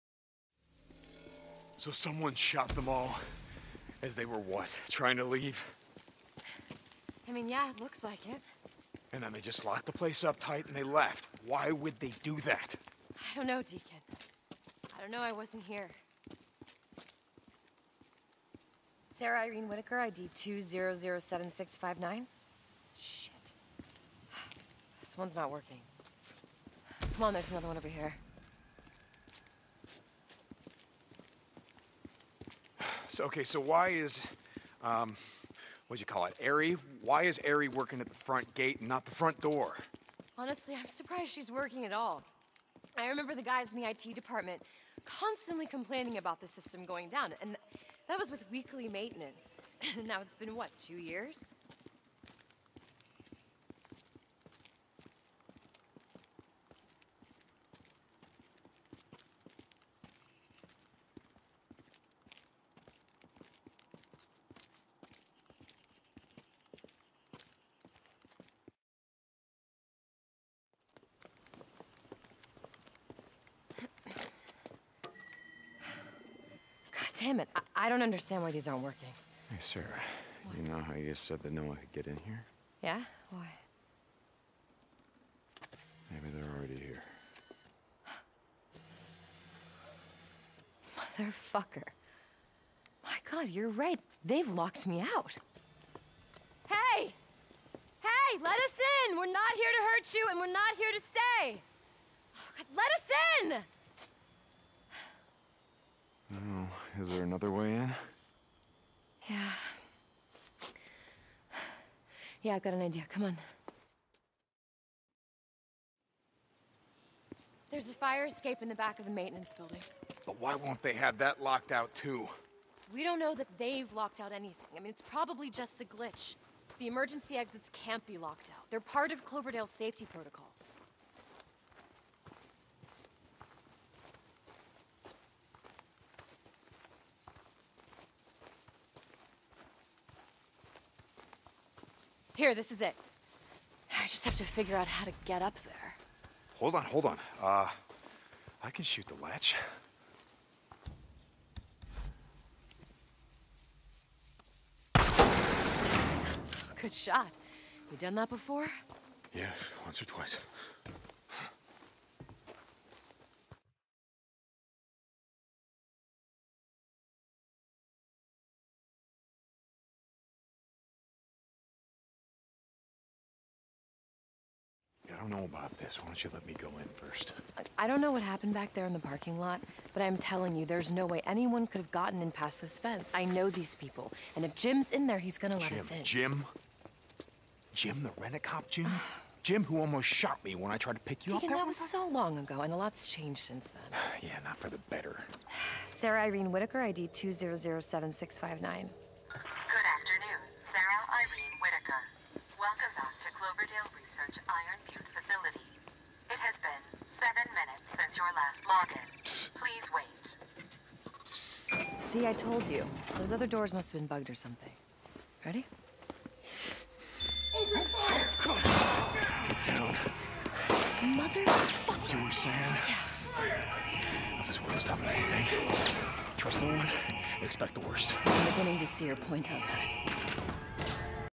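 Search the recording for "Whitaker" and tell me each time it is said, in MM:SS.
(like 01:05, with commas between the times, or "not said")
00:19, 03:16, 03:21.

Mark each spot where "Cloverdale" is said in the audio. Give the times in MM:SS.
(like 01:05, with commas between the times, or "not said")
02:09, 03:23.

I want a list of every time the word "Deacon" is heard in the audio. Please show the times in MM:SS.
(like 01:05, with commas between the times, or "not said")
00:13, 03:11.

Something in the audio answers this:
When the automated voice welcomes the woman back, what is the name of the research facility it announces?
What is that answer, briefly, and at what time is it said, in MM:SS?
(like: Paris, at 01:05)
Iron Butte, at 03:24.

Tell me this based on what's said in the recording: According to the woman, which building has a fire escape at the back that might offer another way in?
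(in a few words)
the maintenance building.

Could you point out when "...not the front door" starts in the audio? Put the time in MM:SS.
00:38.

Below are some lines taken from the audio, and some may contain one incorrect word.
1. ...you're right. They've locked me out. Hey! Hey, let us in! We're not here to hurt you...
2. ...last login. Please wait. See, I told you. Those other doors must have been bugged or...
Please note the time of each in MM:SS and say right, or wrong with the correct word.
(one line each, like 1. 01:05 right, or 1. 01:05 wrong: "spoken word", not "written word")
1. 01:33 right
2. 03:28 right.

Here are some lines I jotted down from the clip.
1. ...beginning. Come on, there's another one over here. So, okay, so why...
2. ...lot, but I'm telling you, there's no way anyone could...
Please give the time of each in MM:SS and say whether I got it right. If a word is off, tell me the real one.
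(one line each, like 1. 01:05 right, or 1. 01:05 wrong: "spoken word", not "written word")
1. 00:25 wrong: "working", not "beginning"
2. 02:59 right.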